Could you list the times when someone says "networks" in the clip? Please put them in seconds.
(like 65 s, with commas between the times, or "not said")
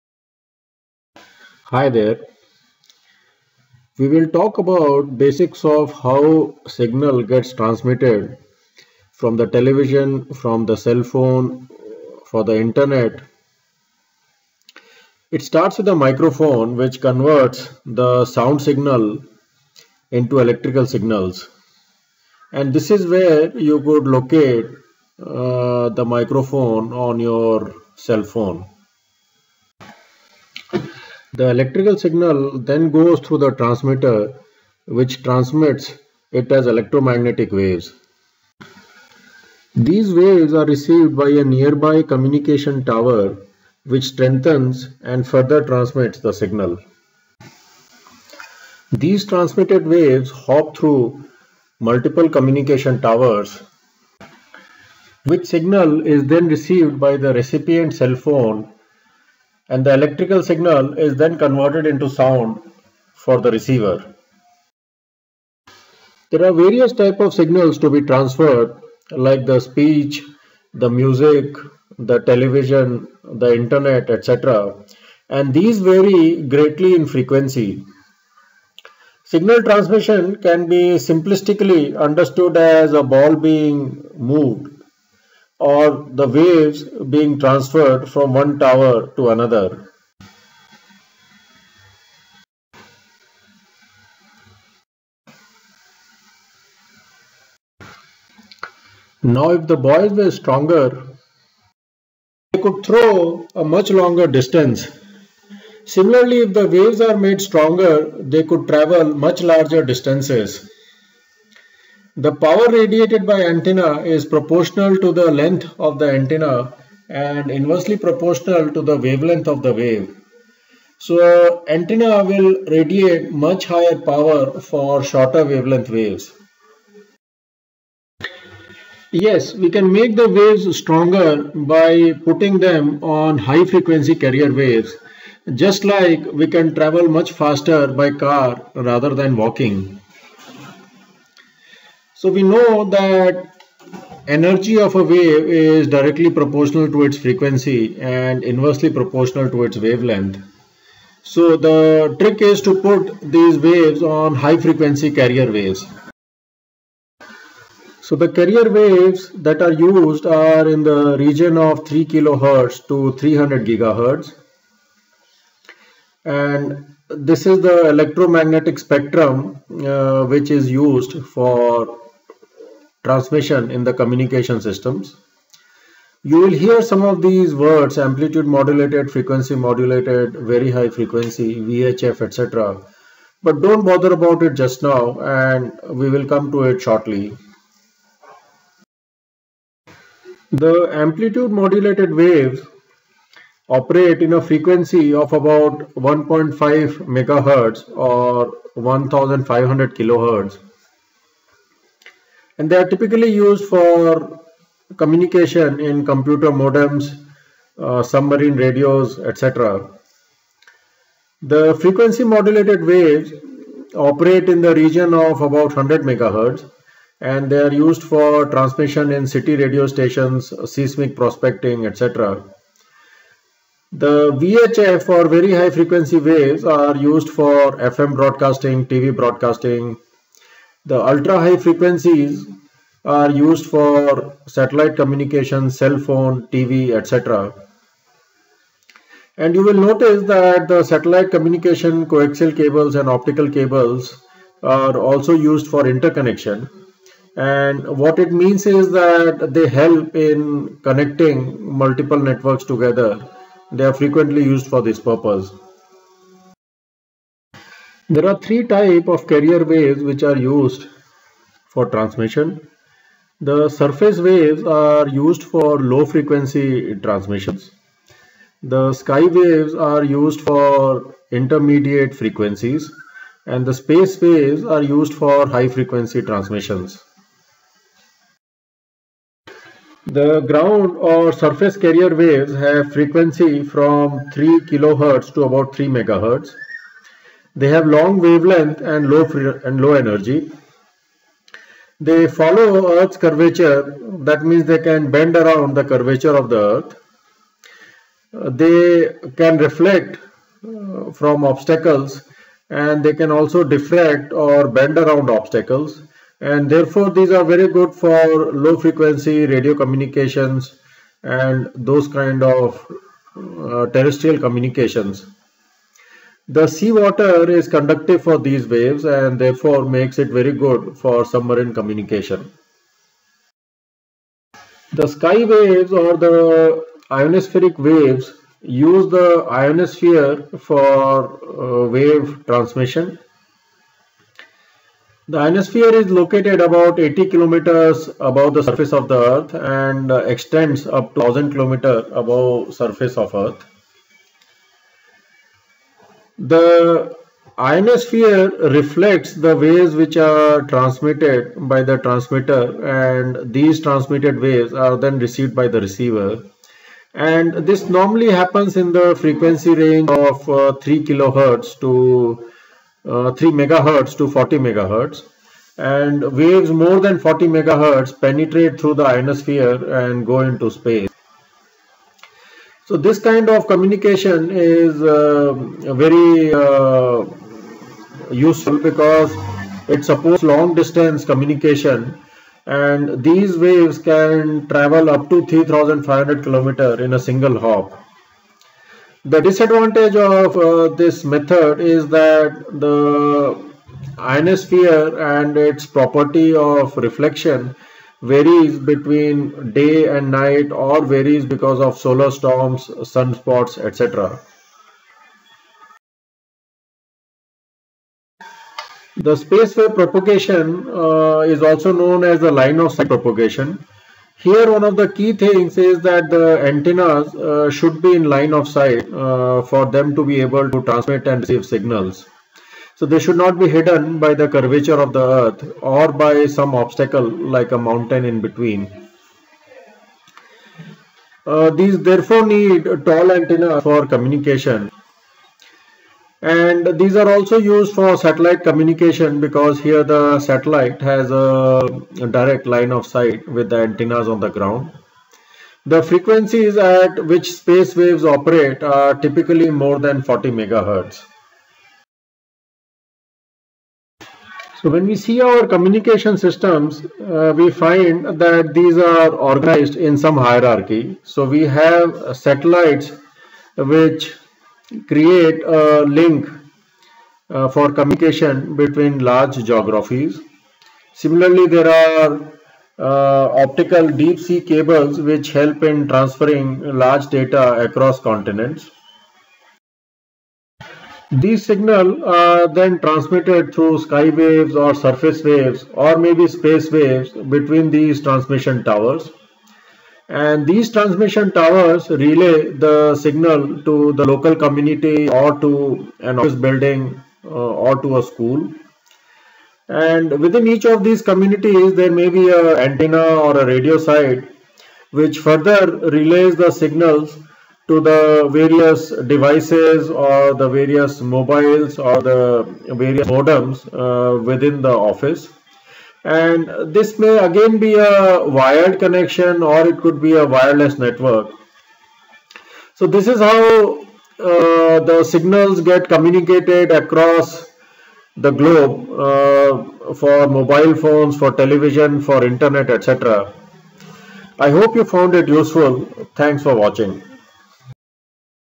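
252 s, 521 s.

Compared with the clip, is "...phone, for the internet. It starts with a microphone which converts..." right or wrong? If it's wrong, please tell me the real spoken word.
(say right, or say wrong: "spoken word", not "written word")
right.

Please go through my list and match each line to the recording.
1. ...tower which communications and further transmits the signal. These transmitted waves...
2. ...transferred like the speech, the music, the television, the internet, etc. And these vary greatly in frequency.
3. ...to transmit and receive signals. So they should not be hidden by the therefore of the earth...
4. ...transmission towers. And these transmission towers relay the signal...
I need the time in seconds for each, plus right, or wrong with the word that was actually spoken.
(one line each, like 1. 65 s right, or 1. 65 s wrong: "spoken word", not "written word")
1. 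42 s wrong: "strengthens", not "communications"
2. 68 s right
3. 420 s wrong: "curvature", not "therefore"
4. 488 s right.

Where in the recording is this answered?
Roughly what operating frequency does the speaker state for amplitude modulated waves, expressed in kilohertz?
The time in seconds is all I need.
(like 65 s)
198 s.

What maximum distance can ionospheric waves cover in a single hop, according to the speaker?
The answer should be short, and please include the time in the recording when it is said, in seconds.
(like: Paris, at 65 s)
3500 km, at 385 s.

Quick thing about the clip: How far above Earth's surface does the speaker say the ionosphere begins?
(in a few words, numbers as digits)
80 km.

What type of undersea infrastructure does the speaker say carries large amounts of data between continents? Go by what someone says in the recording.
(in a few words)
Optical deep sea cables.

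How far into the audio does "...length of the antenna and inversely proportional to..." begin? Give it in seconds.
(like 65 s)
115 s.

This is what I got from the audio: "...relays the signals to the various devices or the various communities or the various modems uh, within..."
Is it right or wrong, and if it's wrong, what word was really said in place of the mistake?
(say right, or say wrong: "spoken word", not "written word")
wrong: "mobiles", not "communities".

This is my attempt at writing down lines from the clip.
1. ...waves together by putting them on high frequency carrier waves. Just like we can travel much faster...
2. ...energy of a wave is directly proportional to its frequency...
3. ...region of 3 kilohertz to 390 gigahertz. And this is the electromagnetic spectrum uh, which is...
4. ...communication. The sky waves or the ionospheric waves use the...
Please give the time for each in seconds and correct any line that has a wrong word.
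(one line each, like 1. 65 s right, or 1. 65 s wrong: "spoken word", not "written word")
1. 130 s wrong: "stronger", not "together"
2. 144 s right
3. 161 s wrong: "300", not "390"
4. 321 s right.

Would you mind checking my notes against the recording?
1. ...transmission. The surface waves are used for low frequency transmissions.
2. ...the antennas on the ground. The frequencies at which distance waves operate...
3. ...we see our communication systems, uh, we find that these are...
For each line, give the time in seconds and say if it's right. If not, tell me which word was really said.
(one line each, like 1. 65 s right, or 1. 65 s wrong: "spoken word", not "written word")
1. 261 s right
2. 443 s wrong: "space", not "distance"
3. 455 s right.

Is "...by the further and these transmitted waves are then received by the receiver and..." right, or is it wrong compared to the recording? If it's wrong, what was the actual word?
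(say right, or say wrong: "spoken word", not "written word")
wrong: "transmitter", not "further".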